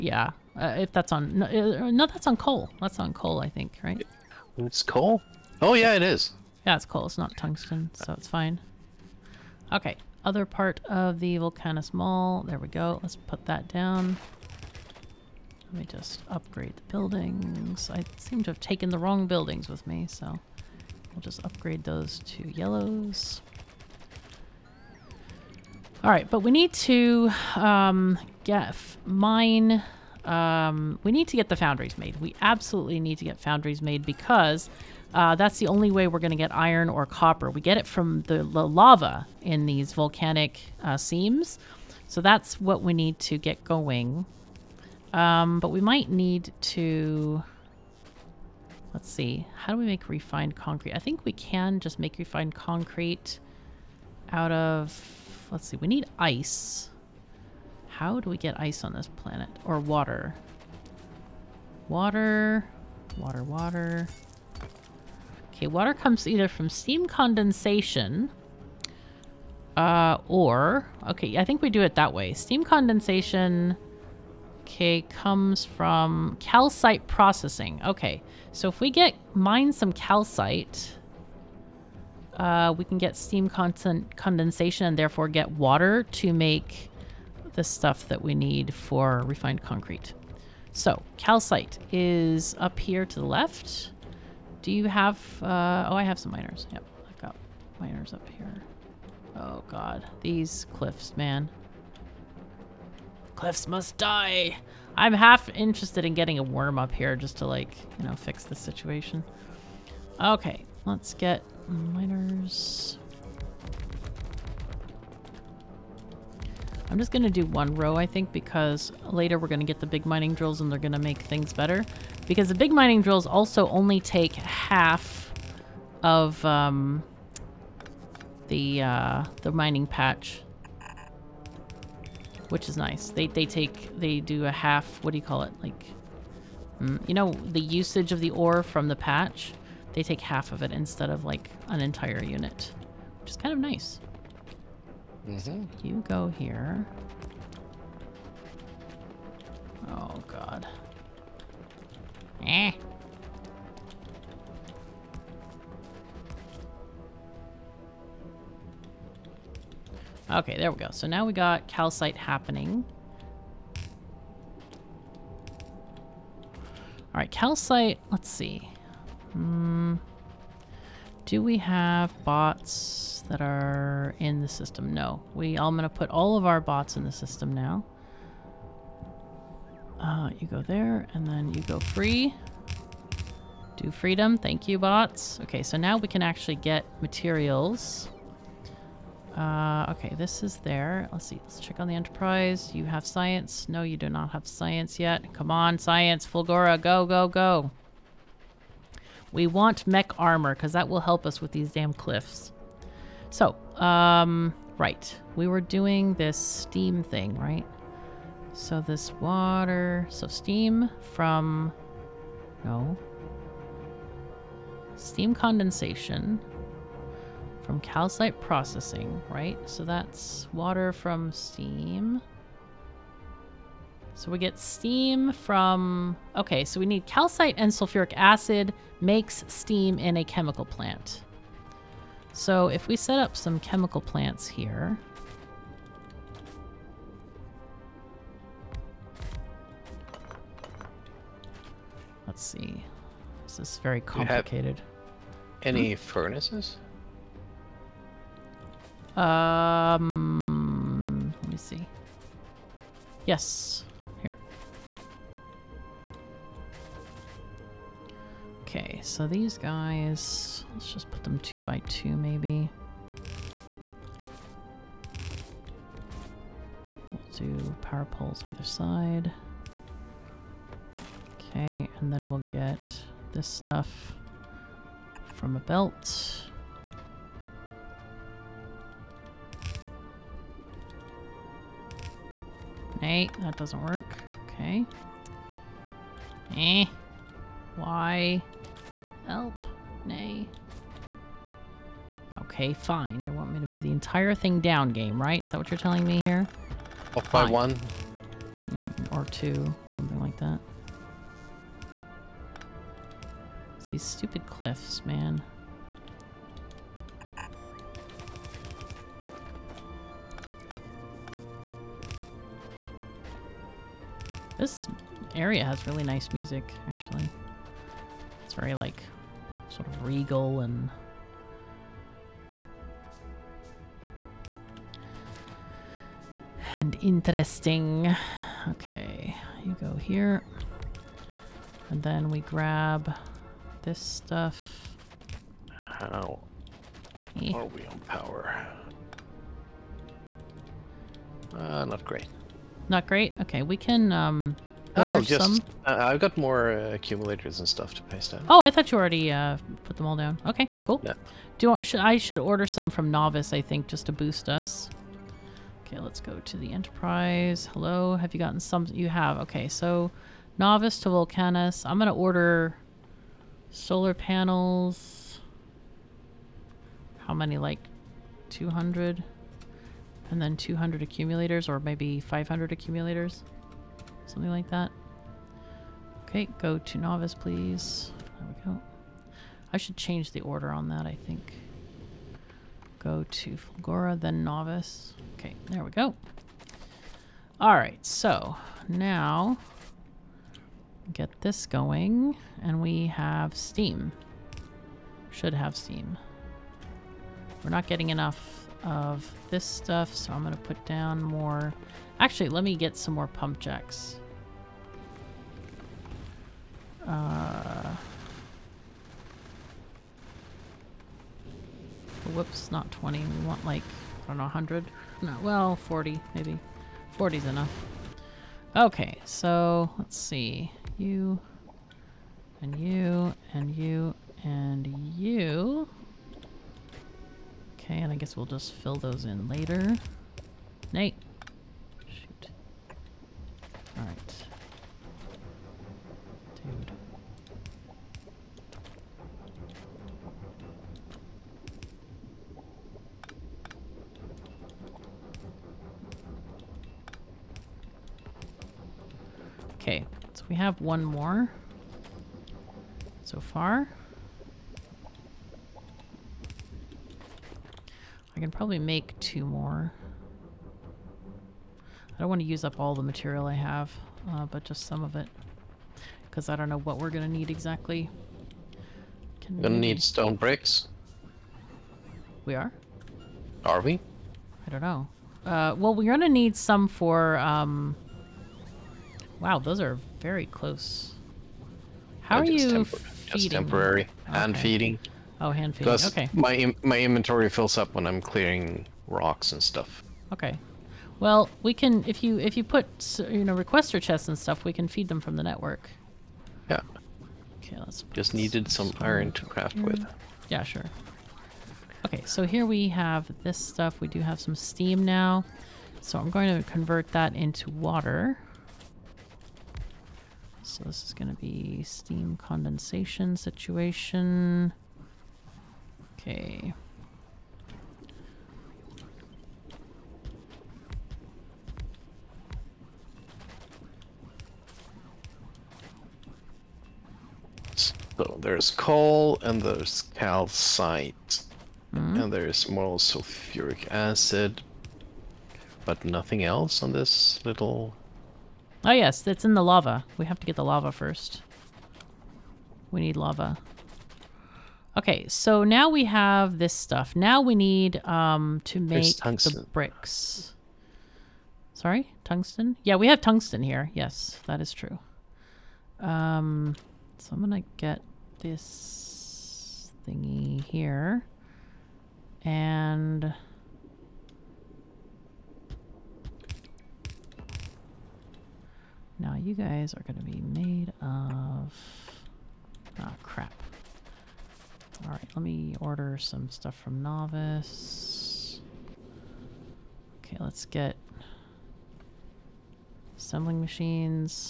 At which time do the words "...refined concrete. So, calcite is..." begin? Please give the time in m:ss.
1:29.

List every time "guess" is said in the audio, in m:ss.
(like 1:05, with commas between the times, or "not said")
7:08.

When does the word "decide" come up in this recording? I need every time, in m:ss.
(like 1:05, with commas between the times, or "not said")
not said.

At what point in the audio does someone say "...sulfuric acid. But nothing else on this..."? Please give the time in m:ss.
8:52.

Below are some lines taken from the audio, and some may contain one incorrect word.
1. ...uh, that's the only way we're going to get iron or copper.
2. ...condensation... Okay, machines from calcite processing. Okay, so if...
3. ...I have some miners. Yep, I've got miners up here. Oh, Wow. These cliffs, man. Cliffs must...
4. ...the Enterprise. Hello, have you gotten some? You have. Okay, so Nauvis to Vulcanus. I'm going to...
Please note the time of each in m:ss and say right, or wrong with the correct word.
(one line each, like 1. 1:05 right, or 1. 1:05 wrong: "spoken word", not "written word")
1. 0:35 right
2. 1:12 wrong: "comes", not "machines"
3. 1:35 wrong: "God", not "Wow"
4. 5:56 right.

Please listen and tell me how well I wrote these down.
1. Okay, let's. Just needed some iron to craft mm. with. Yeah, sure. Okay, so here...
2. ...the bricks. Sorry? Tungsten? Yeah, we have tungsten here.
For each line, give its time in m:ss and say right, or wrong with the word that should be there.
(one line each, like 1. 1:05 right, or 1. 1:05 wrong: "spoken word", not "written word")
1. 8:17 right
2. 9:09 right.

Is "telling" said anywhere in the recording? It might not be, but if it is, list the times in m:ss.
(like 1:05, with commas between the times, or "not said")
4:55.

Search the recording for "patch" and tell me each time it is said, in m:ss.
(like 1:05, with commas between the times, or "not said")
2:09, 2:18.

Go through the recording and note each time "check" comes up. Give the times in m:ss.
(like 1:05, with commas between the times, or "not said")
3:11.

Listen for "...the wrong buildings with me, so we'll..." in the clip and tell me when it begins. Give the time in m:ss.
0:18.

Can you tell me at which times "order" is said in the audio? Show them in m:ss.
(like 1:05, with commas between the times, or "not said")
5:52, 6:02, 6:20, 9:35.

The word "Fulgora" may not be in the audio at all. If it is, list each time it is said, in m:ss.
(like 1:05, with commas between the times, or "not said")
3:16, 6:23.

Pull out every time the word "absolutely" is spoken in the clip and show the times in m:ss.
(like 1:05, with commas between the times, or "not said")
0:32.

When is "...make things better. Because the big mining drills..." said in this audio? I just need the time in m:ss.
2:00.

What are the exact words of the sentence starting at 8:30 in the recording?
So this is going to be steam condensation situation.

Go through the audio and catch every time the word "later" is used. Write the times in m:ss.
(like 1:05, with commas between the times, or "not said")
1:59, 7:09.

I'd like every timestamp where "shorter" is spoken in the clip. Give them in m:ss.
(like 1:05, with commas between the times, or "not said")
not said.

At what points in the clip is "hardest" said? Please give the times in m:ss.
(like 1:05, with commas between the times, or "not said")
not said.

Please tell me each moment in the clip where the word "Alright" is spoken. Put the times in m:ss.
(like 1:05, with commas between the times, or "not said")
2:47, 6:27, 7:13, 9:35.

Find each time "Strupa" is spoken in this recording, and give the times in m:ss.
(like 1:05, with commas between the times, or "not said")
not said.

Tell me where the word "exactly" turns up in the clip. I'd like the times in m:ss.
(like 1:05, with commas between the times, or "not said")
7:47.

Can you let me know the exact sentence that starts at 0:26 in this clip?
All right, but we need to um, get mine.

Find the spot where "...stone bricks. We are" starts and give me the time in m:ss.
7:50.